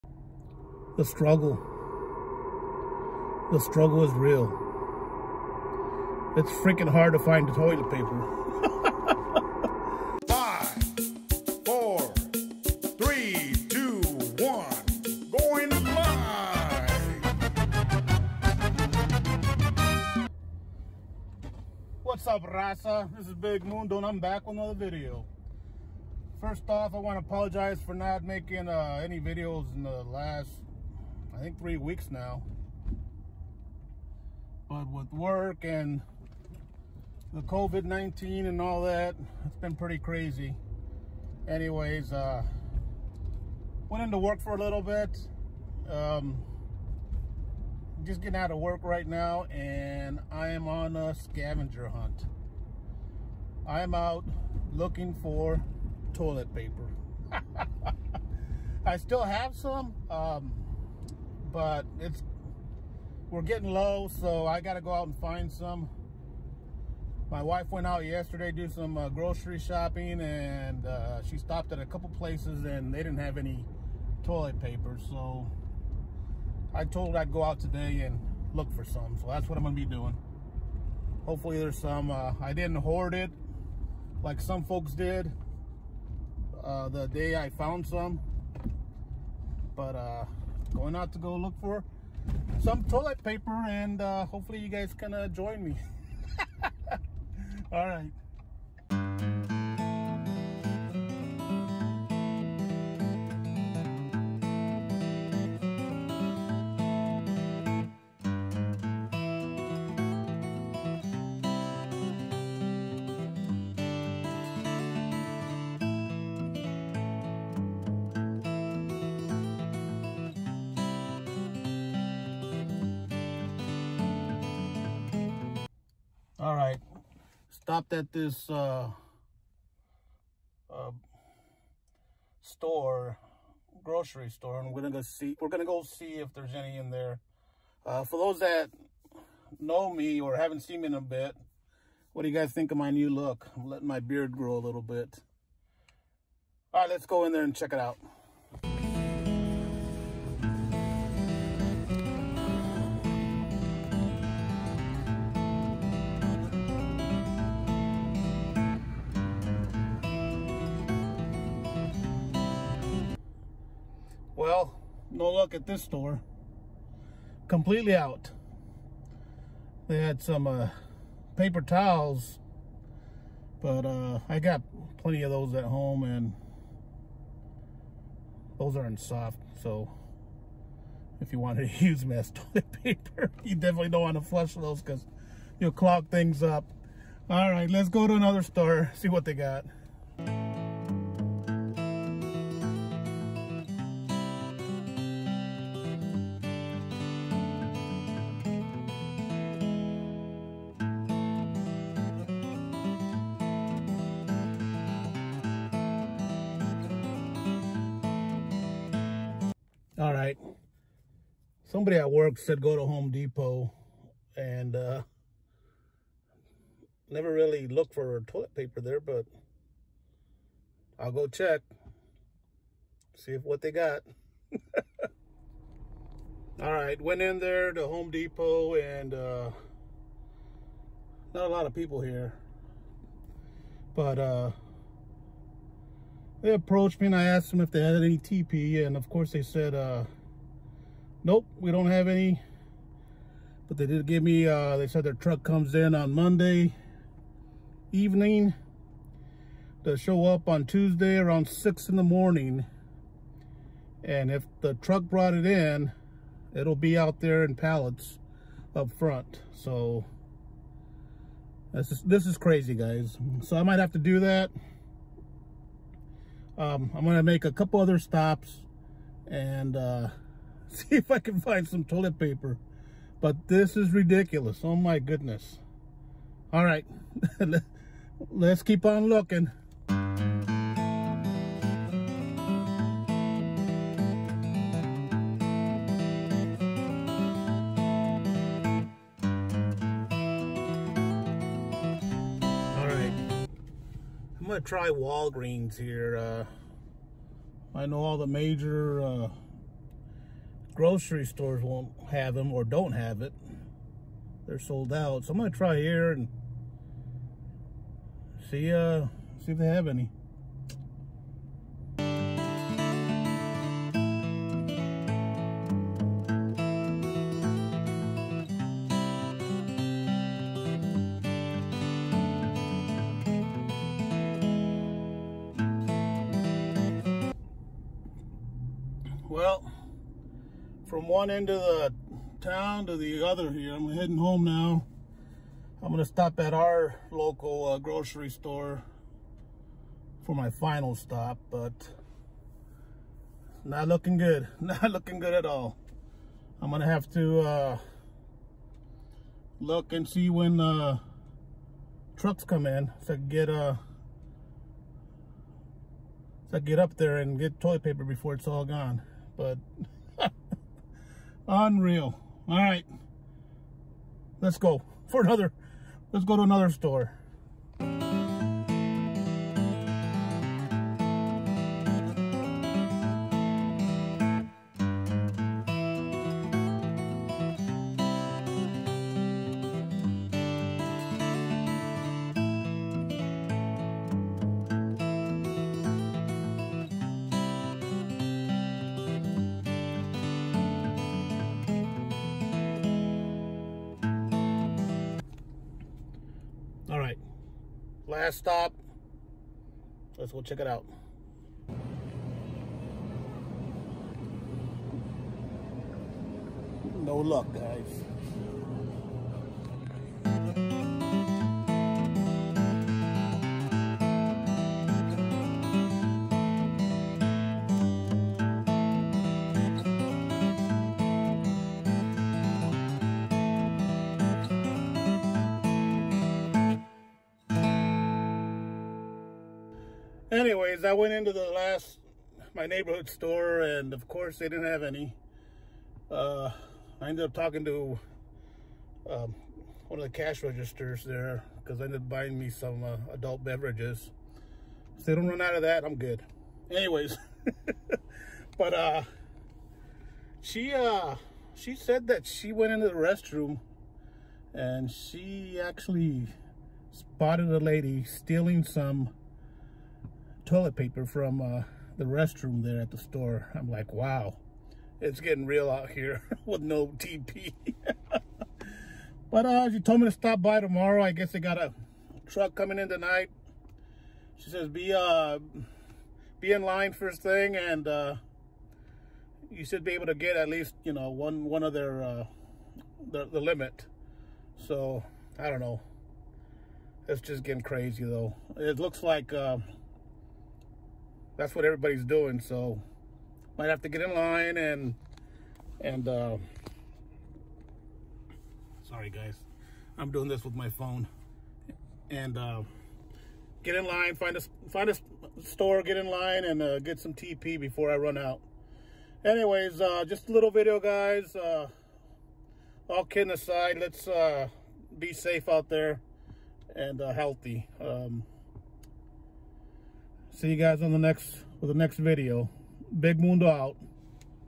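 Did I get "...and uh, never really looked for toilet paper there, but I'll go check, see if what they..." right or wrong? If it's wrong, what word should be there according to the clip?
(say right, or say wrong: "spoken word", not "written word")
right.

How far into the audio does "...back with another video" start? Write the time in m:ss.
0:24.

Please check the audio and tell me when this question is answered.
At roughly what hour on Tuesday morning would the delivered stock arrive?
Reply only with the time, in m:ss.
4:11.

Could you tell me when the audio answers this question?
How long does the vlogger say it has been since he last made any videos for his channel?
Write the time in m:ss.
0:31.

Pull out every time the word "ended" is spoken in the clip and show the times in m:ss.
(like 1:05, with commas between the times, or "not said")
7:17, 7:21.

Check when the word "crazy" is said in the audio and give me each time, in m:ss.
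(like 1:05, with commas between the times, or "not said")
0:39, 4:22, 8:07.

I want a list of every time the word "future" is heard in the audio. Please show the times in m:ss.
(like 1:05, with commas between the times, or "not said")
not said.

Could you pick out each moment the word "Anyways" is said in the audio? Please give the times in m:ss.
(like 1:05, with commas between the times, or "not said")
0:41, 7:10, 7:26, 8:29.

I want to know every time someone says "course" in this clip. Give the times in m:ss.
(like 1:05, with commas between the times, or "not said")
3:59, 7:14.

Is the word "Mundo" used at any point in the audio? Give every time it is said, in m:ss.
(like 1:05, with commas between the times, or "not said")
0:23, 8:43.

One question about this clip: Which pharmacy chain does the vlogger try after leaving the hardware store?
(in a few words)
Walgreens.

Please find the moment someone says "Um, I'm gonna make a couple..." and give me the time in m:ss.
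4:26.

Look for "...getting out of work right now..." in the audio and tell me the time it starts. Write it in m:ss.
0:48.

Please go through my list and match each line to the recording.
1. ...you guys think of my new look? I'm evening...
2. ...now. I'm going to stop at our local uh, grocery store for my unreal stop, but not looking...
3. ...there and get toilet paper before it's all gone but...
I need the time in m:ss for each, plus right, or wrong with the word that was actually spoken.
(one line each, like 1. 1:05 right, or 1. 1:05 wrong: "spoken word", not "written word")
1. 2:22 wrong: "letting", not "evening"
2. 5:34 wrong: "final", not "unreal"
3. 5:56 right.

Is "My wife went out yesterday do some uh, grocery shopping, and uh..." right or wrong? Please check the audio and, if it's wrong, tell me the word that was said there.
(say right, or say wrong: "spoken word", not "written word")
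right.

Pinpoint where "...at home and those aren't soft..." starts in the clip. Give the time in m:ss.
2:55.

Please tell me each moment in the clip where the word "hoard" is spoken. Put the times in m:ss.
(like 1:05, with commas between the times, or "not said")
1:22.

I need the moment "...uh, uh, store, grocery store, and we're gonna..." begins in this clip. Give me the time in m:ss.
2:08.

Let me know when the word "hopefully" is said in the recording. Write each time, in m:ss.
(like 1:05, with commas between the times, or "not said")
1:21, 1:34.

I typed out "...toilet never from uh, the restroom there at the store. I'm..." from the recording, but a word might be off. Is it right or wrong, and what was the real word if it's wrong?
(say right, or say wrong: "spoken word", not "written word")
wrong: "paper", not "never".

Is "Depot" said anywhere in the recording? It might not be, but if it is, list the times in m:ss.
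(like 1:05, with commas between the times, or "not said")
3:33, 3:48.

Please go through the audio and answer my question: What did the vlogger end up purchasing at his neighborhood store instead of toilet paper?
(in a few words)
adult beverages.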